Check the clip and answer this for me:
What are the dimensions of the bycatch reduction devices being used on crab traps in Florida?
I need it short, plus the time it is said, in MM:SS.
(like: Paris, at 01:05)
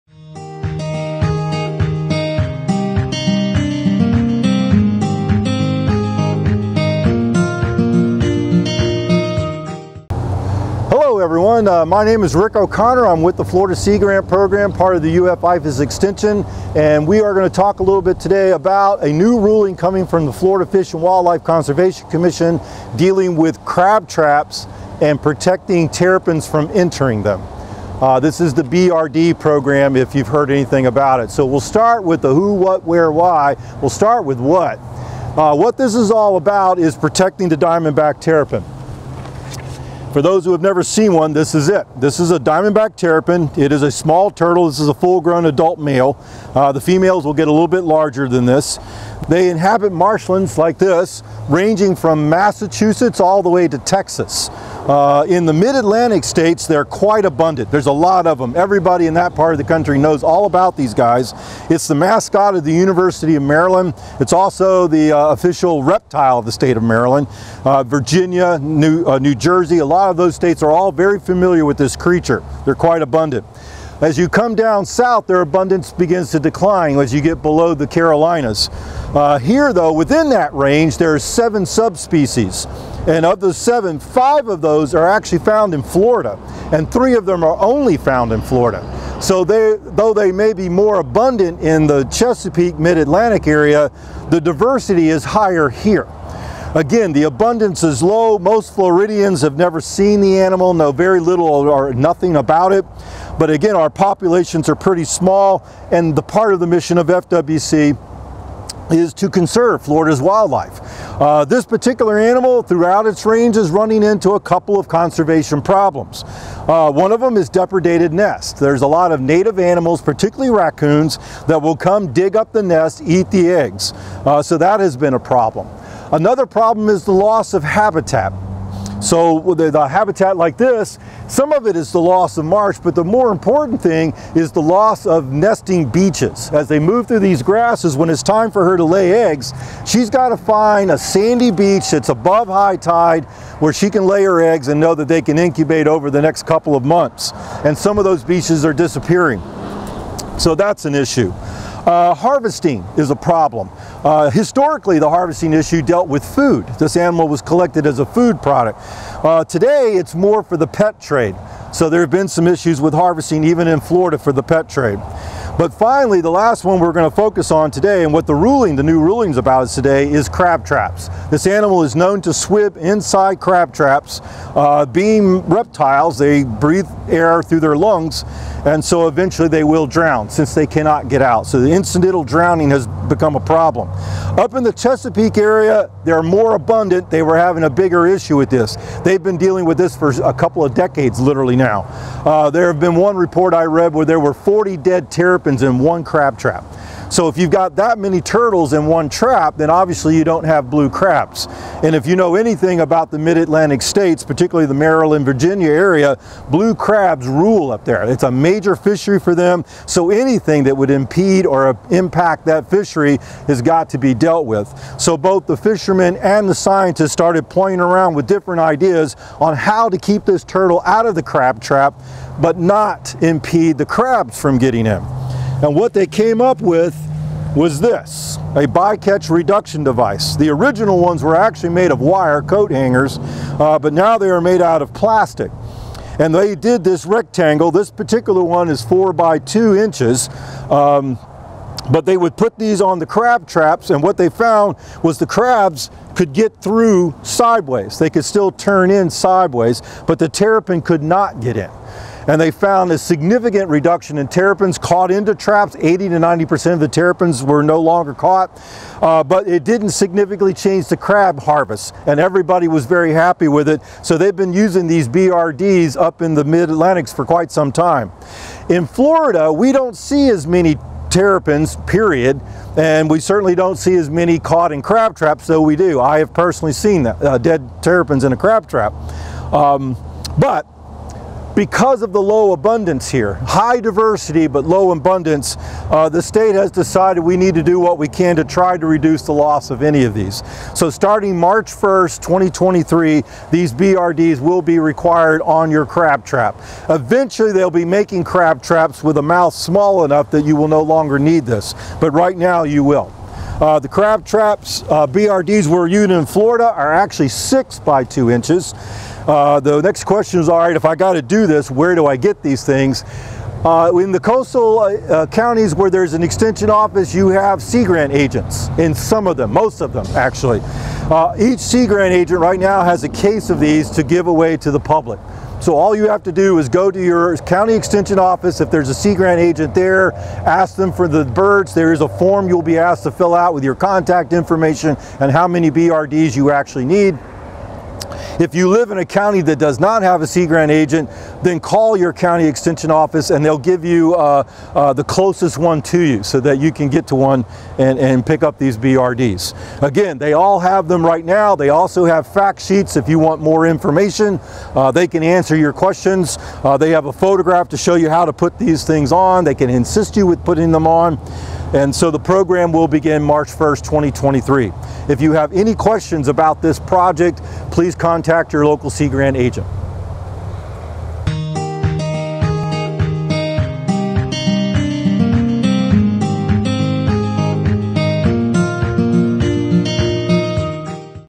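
6 by 2 inches, at 05:07.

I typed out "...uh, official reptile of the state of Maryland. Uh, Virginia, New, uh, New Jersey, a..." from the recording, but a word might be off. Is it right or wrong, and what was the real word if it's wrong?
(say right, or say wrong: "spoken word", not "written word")
right.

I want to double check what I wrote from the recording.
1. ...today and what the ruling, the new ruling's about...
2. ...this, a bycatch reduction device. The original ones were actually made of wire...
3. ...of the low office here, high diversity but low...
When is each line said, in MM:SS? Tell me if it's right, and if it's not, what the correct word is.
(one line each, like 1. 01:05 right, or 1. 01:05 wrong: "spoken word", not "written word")
1. 02:47 right
2. 03:47 right
3. 04:42 wrong: "abundance", not "office".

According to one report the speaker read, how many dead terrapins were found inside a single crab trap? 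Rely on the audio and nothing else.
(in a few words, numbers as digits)
40.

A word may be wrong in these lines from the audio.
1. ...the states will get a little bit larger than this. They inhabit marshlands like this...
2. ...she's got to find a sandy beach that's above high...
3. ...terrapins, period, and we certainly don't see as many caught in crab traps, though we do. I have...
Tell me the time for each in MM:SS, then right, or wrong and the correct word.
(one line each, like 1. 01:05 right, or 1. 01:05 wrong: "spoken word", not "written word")
1. 00:46 wrong: "females", not "states"
2. 02:19 right
3. 04:31 right.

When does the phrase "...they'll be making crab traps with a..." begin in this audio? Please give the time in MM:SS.
04:57.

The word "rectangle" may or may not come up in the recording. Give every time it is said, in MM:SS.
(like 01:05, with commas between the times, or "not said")
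03:57.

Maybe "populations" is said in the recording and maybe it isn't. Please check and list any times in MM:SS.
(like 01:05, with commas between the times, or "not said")
01:43.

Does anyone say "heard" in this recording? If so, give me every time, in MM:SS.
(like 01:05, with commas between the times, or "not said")
00:30.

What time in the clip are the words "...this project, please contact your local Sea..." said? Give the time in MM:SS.
06:06.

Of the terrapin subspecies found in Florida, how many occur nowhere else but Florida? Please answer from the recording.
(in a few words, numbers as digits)
3.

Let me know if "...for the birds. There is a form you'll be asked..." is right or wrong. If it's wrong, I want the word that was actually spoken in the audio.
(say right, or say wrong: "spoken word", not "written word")
right.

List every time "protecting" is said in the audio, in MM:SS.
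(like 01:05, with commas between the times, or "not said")
00:25, 00:36.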